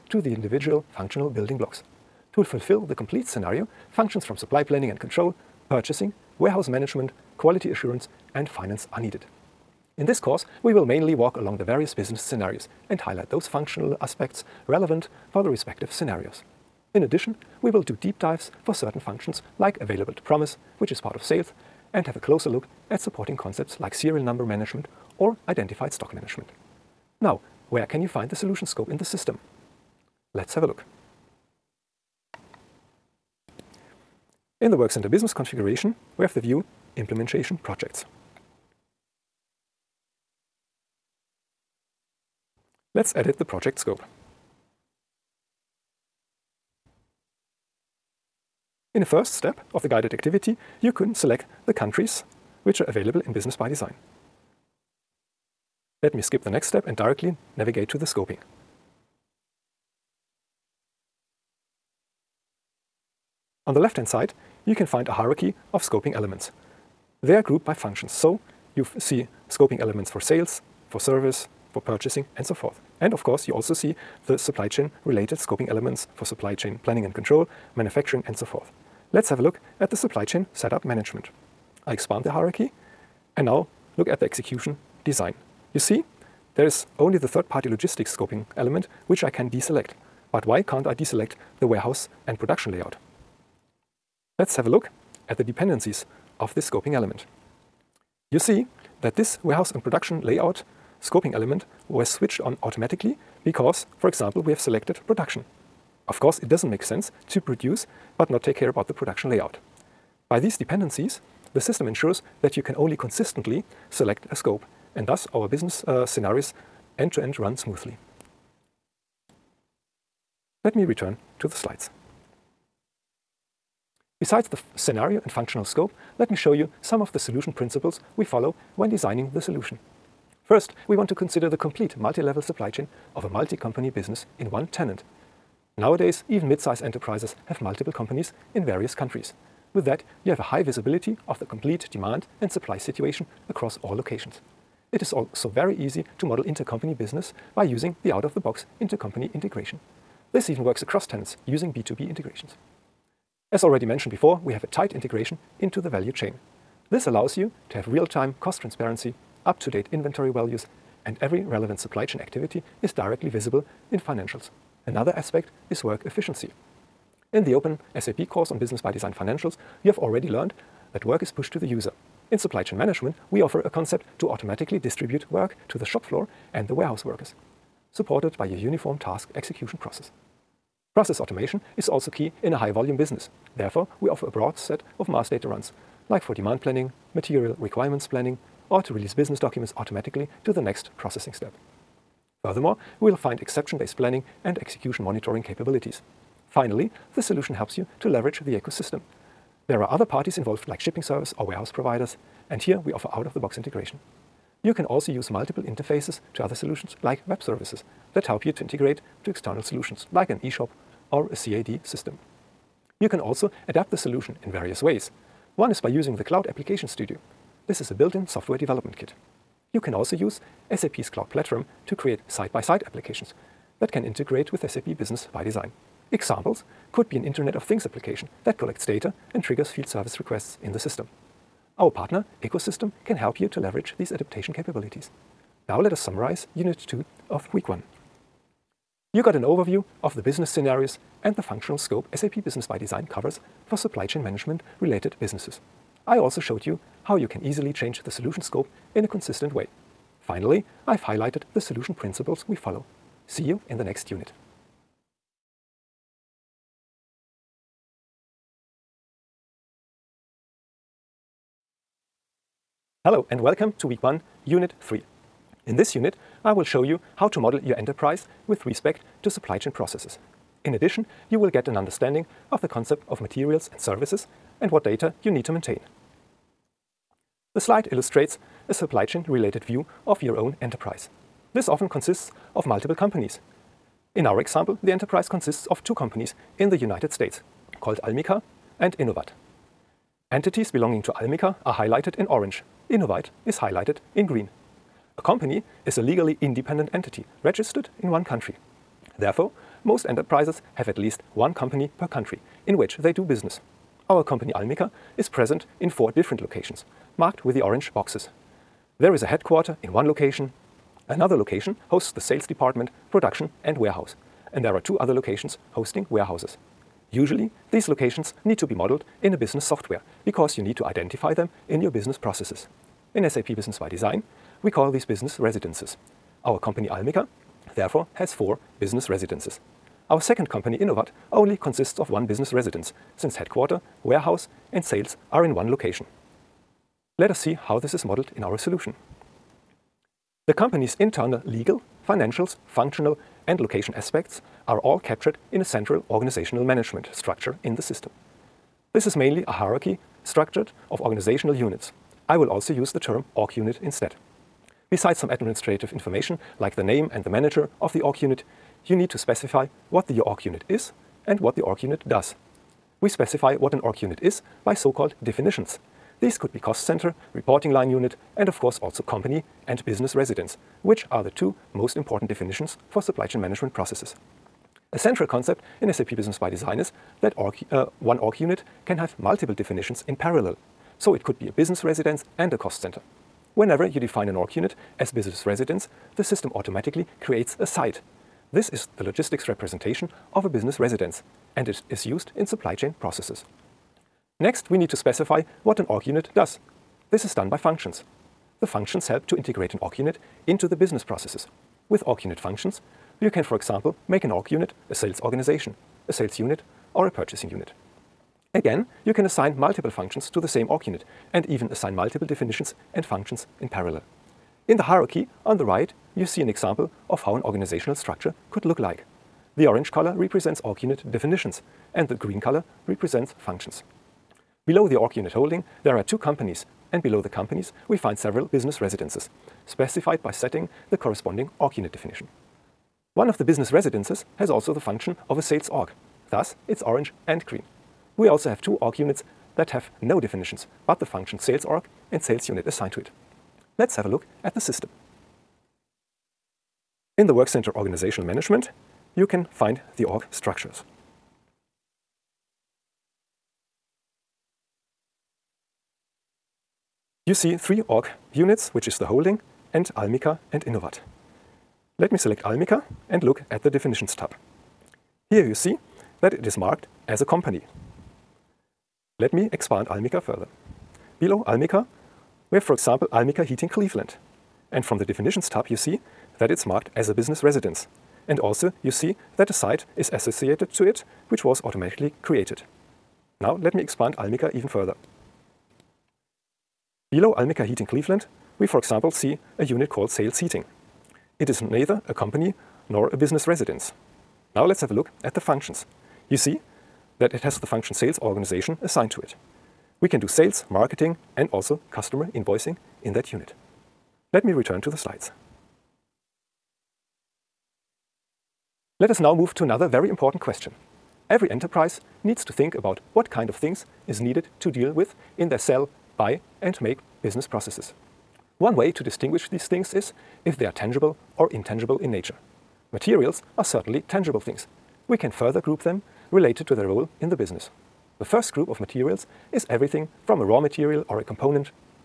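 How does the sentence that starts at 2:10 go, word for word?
First, we want to consider the complete multi-level supply chain of a multi-company business in one tenant.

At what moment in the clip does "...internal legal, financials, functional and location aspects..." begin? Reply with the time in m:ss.
5:40.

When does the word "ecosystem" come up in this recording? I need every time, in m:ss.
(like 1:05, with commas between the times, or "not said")
3:18, 3:52.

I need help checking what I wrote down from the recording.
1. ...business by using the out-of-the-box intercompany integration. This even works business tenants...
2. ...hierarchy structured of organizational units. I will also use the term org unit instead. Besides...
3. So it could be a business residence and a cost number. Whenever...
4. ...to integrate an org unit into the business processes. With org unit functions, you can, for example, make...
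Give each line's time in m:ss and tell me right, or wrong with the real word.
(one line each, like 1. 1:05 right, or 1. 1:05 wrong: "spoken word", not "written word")
1. 2:26 wrong: "across", not "business"
2. 5:49 right
3. 6:20 wrong: "center", not "number"
4. 6:39 right.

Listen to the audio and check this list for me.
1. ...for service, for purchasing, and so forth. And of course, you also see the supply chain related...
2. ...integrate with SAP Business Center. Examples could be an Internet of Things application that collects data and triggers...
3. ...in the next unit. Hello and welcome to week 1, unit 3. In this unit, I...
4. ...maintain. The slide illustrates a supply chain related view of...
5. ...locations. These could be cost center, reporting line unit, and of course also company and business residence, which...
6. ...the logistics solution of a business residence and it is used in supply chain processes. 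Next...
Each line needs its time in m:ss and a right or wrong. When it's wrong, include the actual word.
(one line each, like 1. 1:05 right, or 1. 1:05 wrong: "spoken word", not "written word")
1. 1:10 right
2. 3:44 wrong: "ByDesign", not "Center"
3. 4:13 right
4. 4:35 right
5. 6:05 wrong: "definitions", not "locations"
6. 6:28 wrong: "representation", not "solution".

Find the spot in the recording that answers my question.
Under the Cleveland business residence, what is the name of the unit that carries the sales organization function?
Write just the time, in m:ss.
8:10.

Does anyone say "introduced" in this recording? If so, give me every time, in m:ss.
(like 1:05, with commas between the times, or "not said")
not said.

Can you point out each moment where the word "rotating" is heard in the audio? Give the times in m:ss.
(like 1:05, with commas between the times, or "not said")
not said.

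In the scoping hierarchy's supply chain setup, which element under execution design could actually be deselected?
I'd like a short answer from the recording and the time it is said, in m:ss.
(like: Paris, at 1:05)
third-party logistics, at 1:27.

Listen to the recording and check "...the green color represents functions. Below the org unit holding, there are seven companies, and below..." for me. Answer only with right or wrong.
wrong.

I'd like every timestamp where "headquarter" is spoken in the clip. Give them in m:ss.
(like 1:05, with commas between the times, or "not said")
5:09, 5:33.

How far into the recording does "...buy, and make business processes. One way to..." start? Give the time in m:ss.
8:36.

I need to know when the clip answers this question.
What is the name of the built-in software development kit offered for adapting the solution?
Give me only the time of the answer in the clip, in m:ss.
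3:36.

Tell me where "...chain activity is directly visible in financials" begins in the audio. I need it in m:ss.
2:42.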